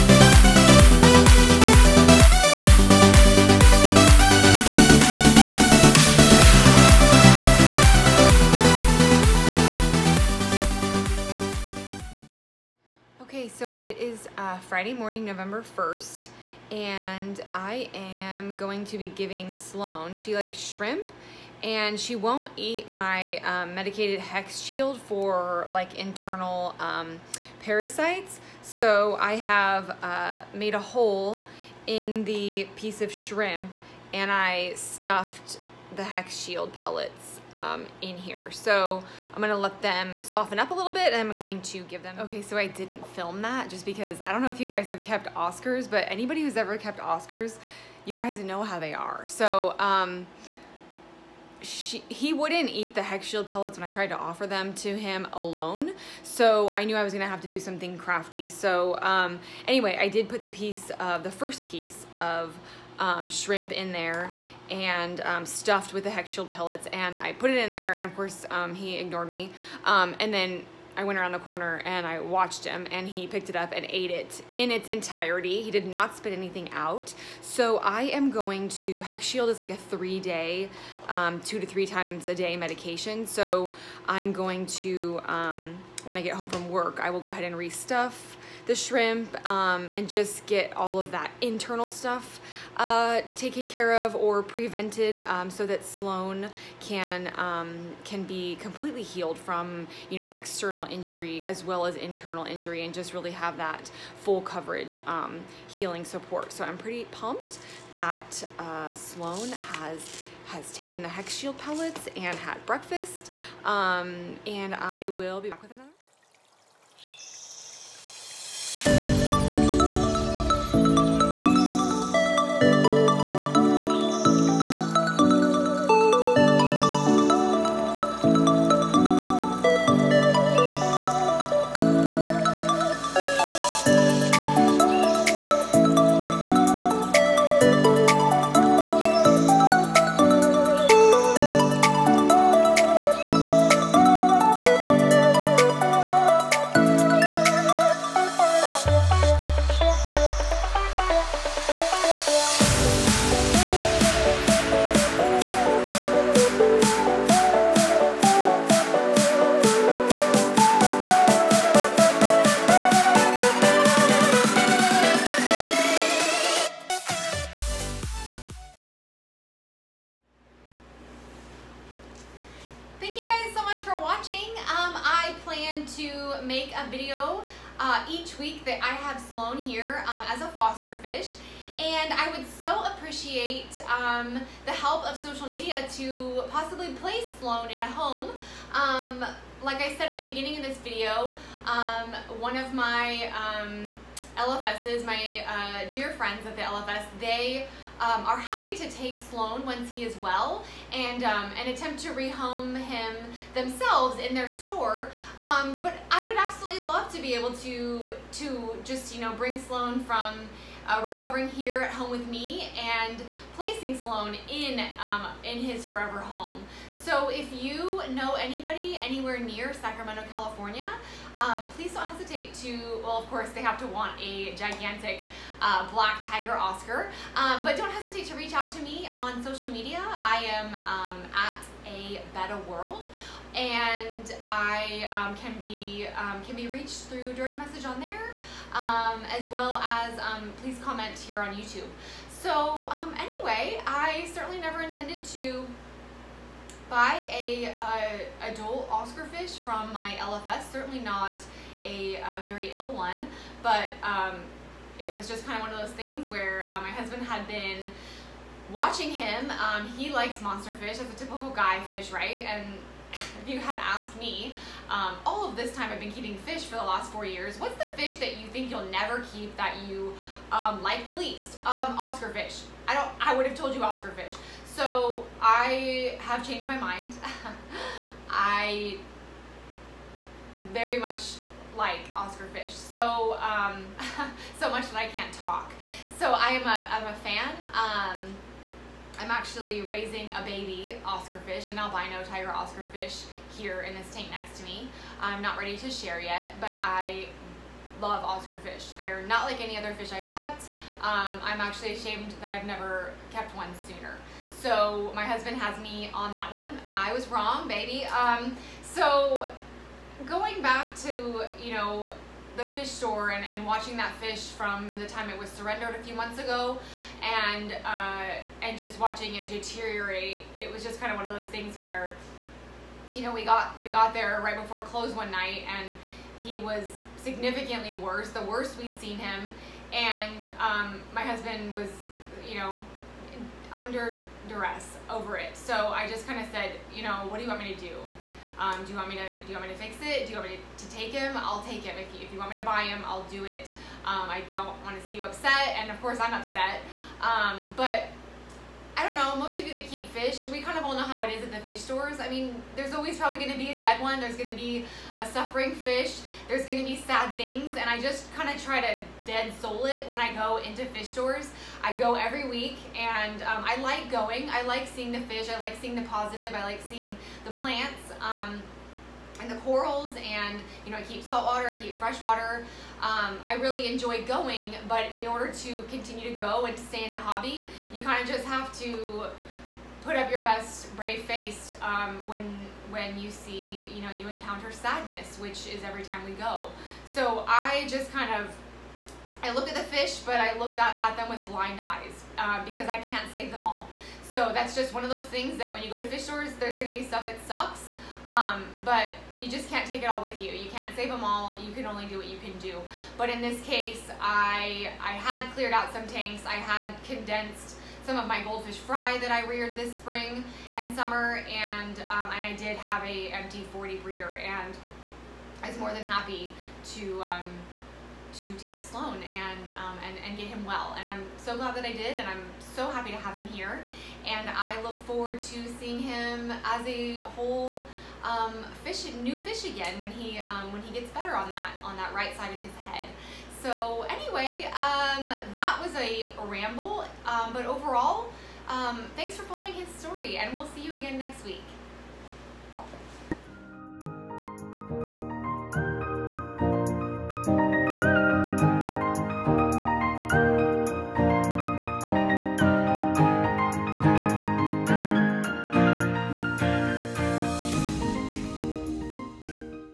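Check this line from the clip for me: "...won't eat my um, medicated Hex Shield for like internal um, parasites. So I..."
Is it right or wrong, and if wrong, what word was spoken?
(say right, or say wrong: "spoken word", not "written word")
right.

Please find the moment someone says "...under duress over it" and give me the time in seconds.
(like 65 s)
333 s.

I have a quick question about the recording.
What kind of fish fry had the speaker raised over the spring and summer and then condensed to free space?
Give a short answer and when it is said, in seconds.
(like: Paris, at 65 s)
Goldfish, at 408 s.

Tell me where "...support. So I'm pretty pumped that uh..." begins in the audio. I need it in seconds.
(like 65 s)
106 s.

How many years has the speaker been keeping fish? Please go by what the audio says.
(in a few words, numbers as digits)
4.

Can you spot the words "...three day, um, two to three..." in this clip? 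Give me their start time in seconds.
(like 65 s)
79 s.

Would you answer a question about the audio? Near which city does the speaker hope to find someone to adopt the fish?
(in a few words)
Sacramento, California.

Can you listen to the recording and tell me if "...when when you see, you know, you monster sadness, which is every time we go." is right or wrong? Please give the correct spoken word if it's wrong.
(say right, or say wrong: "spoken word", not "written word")
wrong: "encounter", not "monster".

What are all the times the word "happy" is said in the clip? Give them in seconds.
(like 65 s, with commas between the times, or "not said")
198 s, 416 s, 422 s.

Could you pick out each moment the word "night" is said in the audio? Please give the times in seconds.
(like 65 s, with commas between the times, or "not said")
325 s.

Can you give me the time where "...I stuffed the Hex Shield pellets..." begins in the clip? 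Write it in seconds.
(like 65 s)
34 s.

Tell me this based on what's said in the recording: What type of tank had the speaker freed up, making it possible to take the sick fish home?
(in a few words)
40 breeder.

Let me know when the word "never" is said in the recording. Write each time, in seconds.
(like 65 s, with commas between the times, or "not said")
244 s, 268 s, 302 s.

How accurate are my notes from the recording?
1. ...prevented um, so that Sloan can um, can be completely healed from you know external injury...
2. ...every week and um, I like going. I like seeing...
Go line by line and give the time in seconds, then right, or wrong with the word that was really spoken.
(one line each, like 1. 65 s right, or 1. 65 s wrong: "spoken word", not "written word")
1. 94 s right
2. 362 s right.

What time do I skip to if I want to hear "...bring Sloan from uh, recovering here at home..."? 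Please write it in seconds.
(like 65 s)
209 s.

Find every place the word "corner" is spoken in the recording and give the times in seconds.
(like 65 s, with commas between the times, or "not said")
71 s.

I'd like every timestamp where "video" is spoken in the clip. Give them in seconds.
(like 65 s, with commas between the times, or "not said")
176 s, 190 s.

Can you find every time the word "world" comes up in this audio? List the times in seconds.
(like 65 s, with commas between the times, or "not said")
232 s.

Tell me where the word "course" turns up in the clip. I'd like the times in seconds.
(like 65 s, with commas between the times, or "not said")
68 s, 223 s, 346 s.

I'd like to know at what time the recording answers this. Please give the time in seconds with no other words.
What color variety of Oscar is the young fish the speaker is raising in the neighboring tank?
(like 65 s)
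291 s.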